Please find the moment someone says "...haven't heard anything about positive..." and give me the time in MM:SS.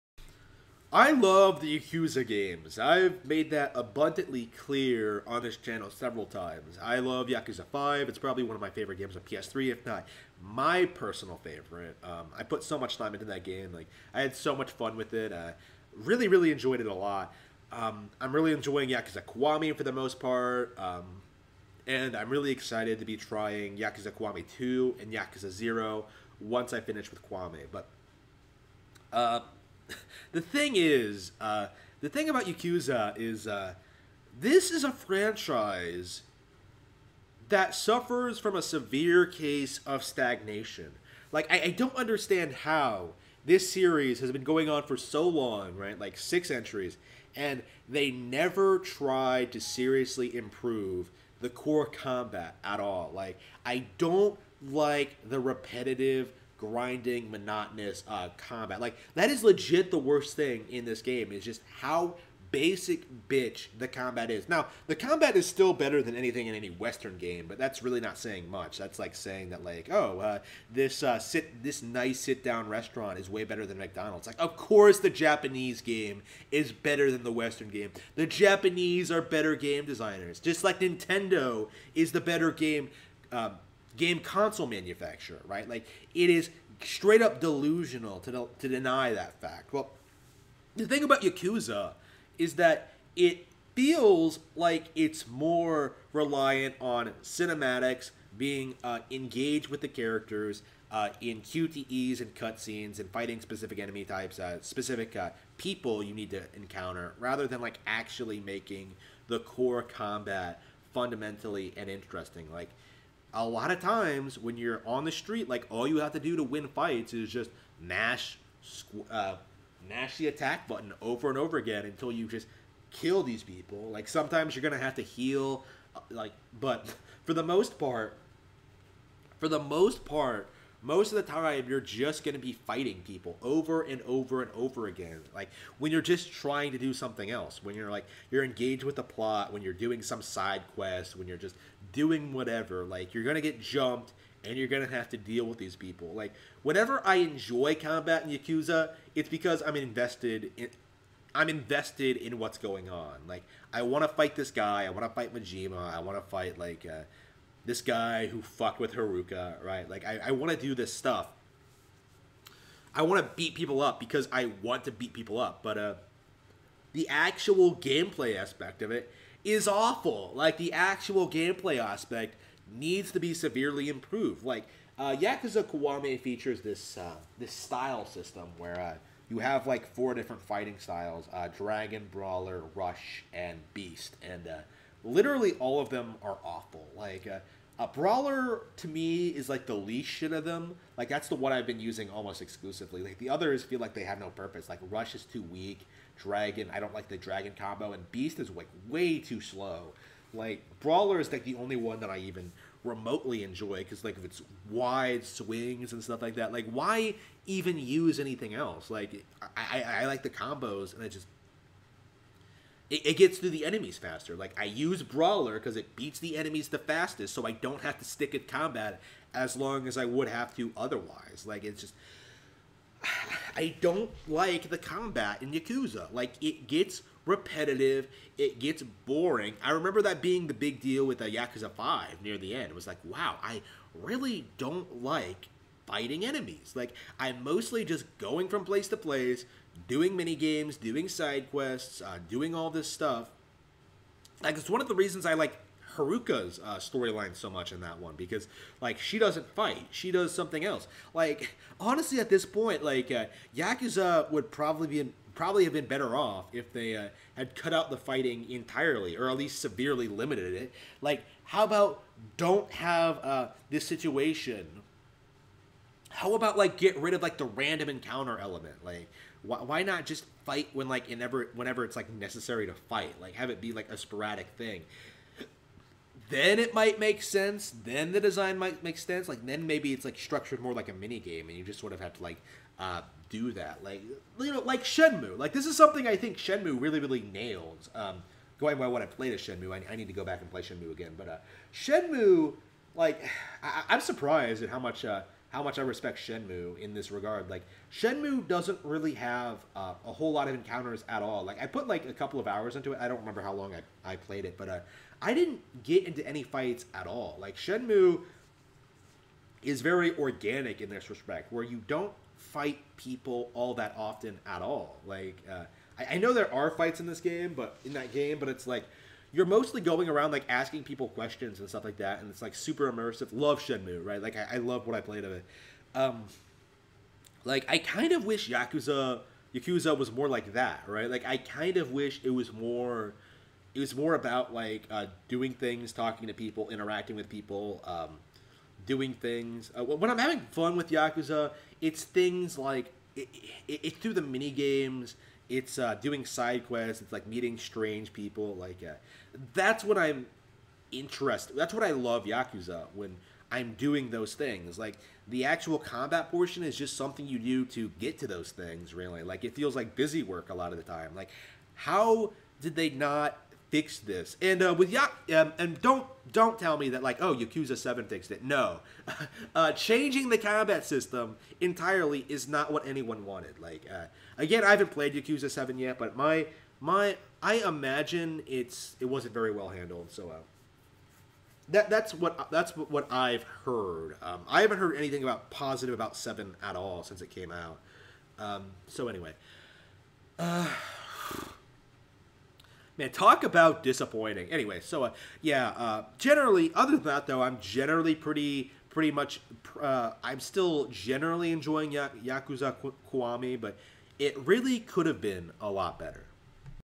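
06:24.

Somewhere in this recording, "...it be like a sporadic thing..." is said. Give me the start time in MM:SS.
04:33.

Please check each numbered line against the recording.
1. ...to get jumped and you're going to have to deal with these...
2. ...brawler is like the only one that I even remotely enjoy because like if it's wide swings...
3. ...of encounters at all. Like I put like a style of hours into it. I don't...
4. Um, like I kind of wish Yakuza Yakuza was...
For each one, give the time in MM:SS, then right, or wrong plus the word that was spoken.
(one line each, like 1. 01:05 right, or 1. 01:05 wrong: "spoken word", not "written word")
1. 02:23 right
2. 03:20 right
3. 05:00 wrong: "couple", not "style"
4. 05:25 right.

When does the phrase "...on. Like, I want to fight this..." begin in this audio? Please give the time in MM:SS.
02:32.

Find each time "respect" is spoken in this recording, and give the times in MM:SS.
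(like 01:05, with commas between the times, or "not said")
04:55, 05:11.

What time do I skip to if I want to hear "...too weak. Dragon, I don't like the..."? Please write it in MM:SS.
03:15.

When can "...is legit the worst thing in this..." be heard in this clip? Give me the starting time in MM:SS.
00:59.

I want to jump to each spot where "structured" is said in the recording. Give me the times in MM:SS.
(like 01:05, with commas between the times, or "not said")
04:40.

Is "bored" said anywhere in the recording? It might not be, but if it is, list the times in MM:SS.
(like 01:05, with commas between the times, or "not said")
not said.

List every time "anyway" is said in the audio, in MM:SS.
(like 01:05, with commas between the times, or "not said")
06:29, 06:34.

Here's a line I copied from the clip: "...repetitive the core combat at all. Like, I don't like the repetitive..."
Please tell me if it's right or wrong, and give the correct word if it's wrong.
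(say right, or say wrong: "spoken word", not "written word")
wrong: "improve", not "repetitive".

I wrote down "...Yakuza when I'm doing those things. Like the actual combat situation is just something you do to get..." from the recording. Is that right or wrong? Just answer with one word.
wrong.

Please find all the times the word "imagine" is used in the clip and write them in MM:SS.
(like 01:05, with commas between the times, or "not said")
06:17.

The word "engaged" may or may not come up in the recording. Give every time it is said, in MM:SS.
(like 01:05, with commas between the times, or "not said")
01:39, 02:18.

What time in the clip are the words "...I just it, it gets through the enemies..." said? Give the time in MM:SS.
03:31.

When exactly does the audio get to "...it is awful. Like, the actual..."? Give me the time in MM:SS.
02:48.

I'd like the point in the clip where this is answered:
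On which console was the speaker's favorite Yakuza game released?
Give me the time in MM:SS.
00:09.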